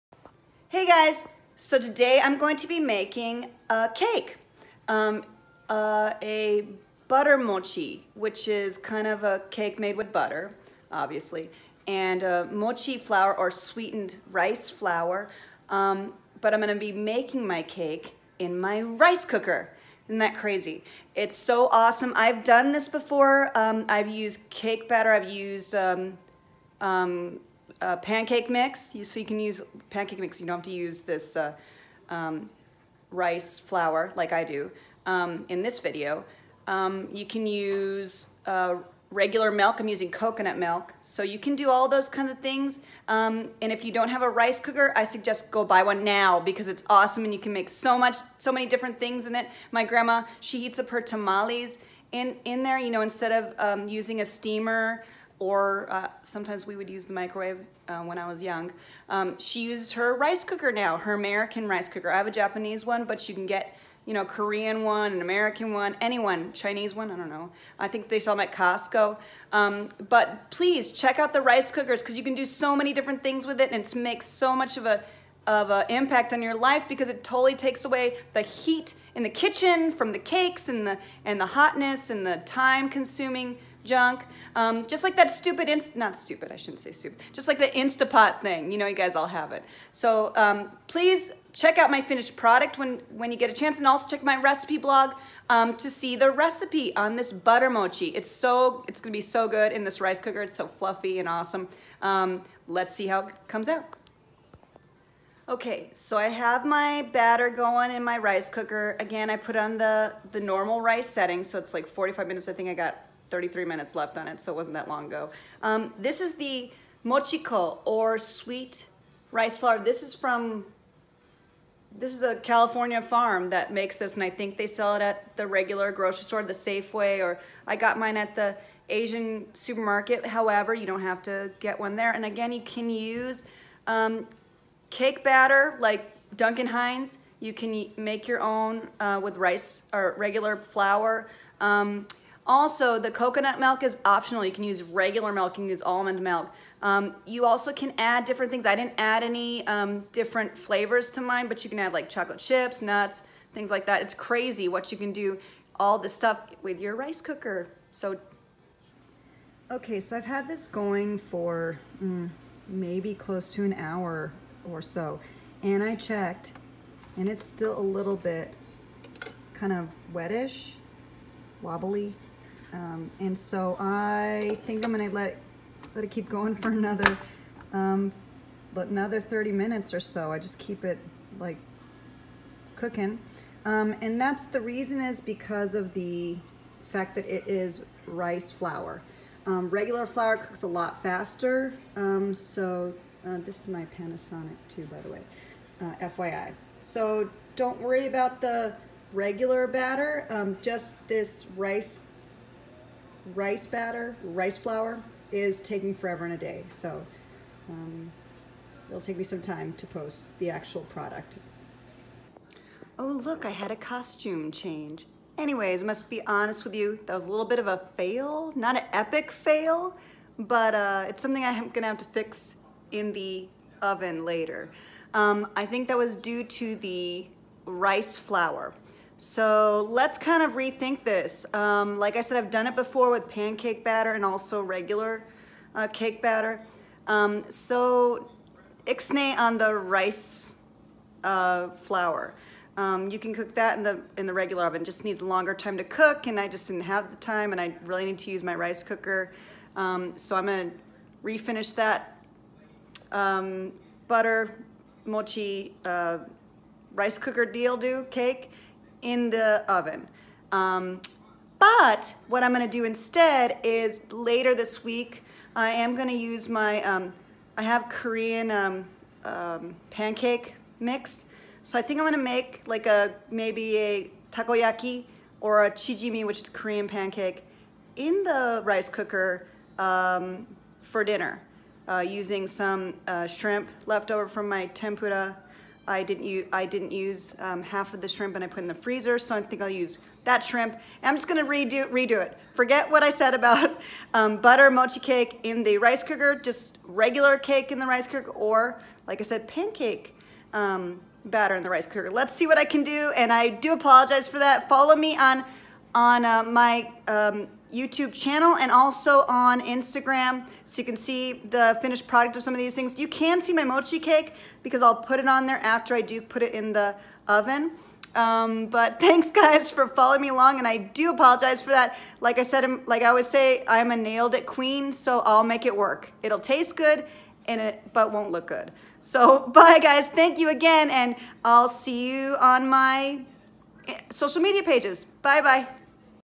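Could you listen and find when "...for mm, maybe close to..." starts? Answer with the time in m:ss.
2:41.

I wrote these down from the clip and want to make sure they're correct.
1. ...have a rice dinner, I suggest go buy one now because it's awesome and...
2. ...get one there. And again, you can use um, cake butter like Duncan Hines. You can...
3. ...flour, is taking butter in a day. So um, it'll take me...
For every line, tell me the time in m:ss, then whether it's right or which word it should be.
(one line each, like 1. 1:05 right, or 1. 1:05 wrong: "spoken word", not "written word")
1. 0:44 wrong: "cooker", not "dinner"
2. 2:11 wrong: "batter", not "butter"
3. 3:24 wrong: "forever", not "butter".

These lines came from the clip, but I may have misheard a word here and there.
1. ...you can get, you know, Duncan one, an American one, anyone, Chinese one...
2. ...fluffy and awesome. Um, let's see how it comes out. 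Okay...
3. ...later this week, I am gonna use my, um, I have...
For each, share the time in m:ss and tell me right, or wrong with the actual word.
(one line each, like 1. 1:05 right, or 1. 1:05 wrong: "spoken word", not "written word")
1. 1:03 wrong: "Korean", not "Duncan"
2. 1:40 right
3. 4:24 right.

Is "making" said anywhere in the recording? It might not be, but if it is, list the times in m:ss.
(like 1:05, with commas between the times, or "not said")
0:02, 0:16.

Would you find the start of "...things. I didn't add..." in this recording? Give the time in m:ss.
2:28.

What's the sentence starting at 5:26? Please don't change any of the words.
It'll taste good and it, but won't look good.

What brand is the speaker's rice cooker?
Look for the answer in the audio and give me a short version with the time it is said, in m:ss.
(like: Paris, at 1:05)
Panasonic, at 3:13.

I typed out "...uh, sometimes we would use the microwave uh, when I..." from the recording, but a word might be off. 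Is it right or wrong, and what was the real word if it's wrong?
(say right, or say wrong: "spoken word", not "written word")
right.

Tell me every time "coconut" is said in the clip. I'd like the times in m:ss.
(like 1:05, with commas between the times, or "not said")
0:40, 2:23.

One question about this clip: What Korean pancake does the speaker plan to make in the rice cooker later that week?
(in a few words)
Chijimi.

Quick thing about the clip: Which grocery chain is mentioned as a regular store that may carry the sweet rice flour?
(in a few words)
Safeway.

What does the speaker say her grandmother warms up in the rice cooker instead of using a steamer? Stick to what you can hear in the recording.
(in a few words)
Tamales.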